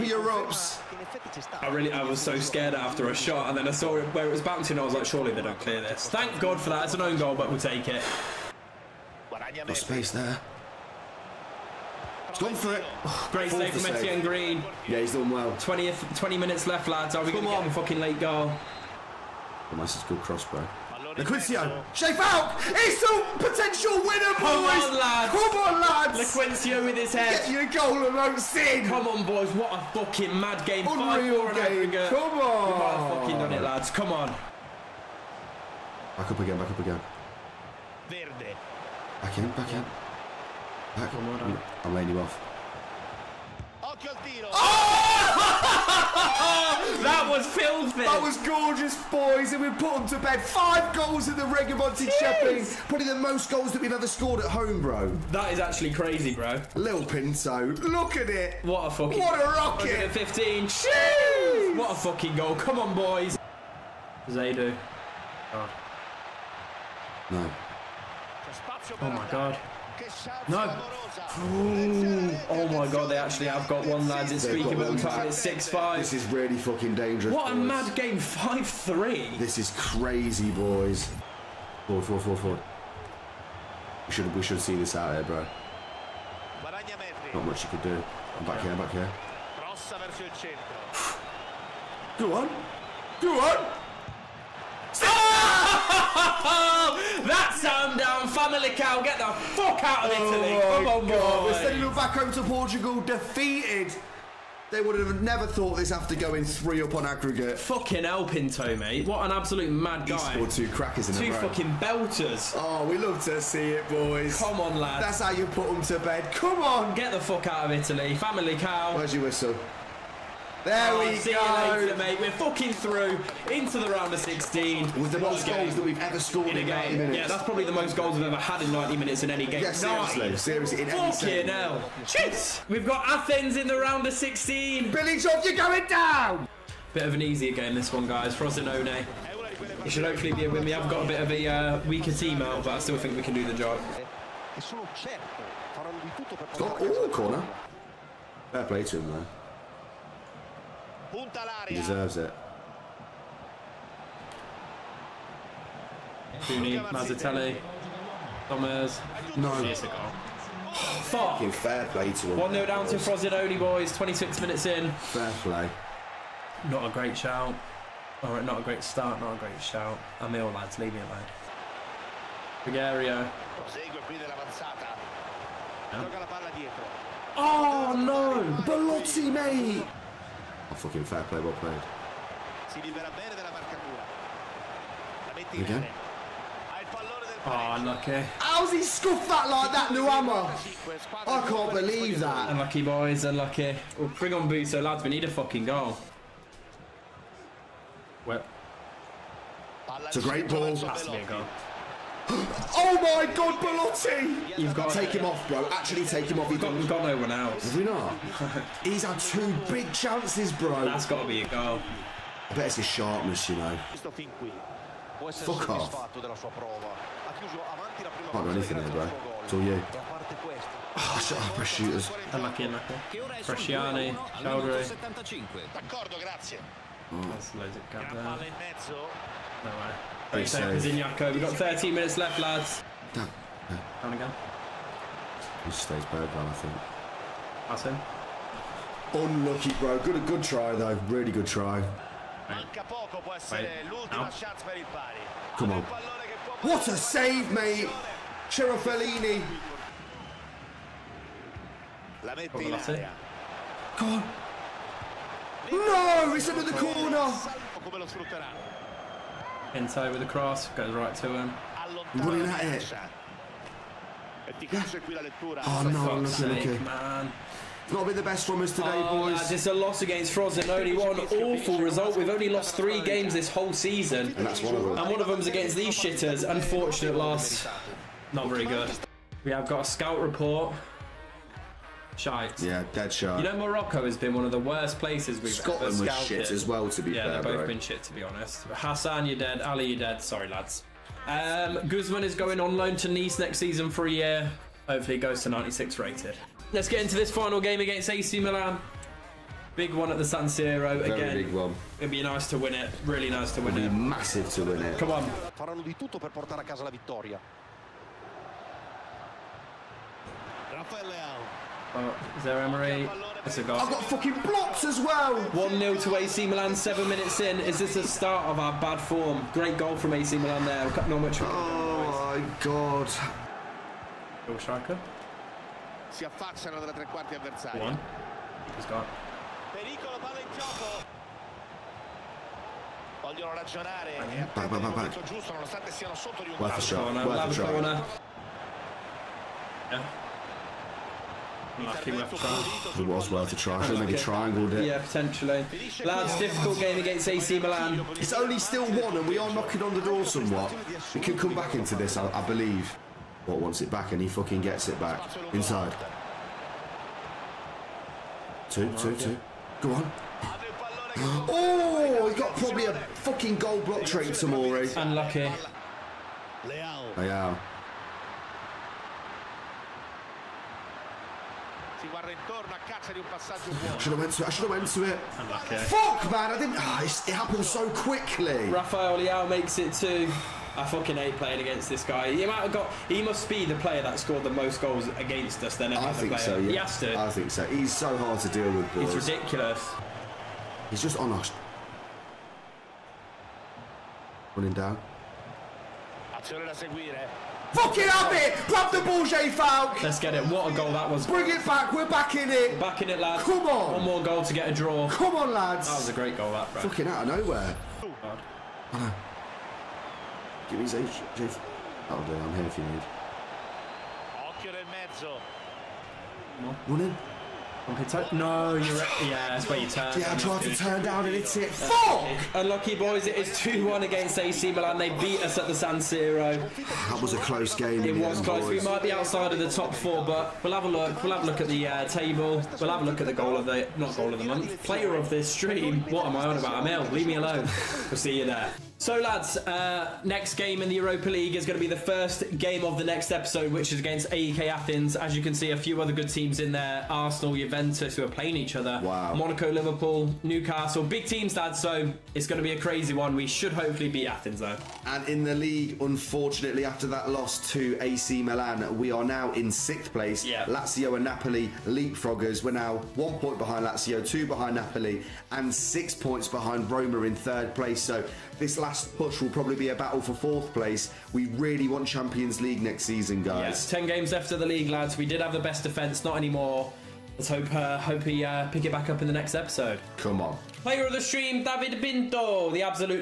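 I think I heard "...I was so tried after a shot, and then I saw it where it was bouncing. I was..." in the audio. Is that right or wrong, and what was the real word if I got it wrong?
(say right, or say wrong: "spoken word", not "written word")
wrong: "scared", not "tried".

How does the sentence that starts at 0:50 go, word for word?
Five goals in the Rigamonti Champion.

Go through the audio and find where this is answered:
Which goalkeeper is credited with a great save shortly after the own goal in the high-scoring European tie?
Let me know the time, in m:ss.
0:13.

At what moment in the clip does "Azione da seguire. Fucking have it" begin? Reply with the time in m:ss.
6:36.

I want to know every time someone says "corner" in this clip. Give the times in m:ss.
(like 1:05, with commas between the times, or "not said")
2:27, 4:16.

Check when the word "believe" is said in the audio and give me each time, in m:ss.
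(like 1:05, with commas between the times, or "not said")
3:11, 5:52.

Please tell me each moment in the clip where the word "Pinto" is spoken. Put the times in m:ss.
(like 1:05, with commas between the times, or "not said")
0:57, 1:48, 8:02.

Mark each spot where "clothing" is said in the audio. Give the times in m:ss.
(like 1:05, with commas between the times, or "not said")
not said.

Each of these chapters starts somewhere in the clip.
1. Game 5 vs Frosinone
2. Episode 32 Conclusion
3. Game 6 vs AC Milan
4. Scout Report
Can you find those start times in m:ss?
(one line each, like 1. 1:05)
1. 2:16
2. 7:18
3. 4:56
4. 4:38.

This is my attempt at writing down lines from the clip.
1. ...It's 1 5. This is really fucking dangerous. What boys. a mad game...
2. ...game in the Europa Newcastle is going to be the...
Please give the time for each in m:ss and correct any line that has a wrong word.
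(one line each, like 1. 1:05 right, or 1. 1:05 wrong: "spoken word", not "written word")
1. 1:15 wrong: "6", not "1"
2. 7:20 wrong: "League", not "Newcastle".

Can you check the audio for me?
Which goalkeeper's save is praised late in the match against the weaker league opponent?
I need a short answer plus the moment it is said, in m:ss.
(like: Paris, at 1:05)
Cerofolini, at 4:08.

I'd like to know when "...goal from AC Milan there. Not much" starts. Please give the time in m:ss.
5:19.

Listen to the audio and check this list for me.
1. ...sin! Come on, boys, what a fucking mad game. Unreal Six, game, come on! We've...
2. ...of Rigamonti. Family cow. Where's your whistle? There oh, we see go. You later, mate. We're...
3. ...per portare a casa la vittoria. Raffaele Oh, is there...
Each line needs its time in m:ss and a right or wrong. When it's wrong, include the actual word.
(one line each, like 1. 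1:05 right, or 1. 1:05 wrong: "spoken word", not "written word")
1. 0:28 wrong: "Five", not "Six"
2. 1:57 wrong: "Italy", not "Rigamonti"
3. 5:06 right.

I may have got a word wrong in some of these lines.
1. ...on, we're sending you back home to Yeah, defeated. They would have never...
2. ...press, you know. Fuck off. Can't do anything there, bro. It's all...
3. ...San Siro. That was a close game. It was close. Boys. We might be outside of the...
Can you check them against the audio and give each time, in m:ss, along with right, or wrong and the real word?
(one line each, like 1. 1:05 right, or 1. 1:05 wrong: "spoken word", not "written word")
1. 1:40 wrong: "Portugal", not "Yeah"
2. 3:32 wrong: "sharpness", not "press"
3. 7:05 right.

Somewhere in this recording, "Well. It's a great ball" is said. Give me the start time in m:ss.
3:18.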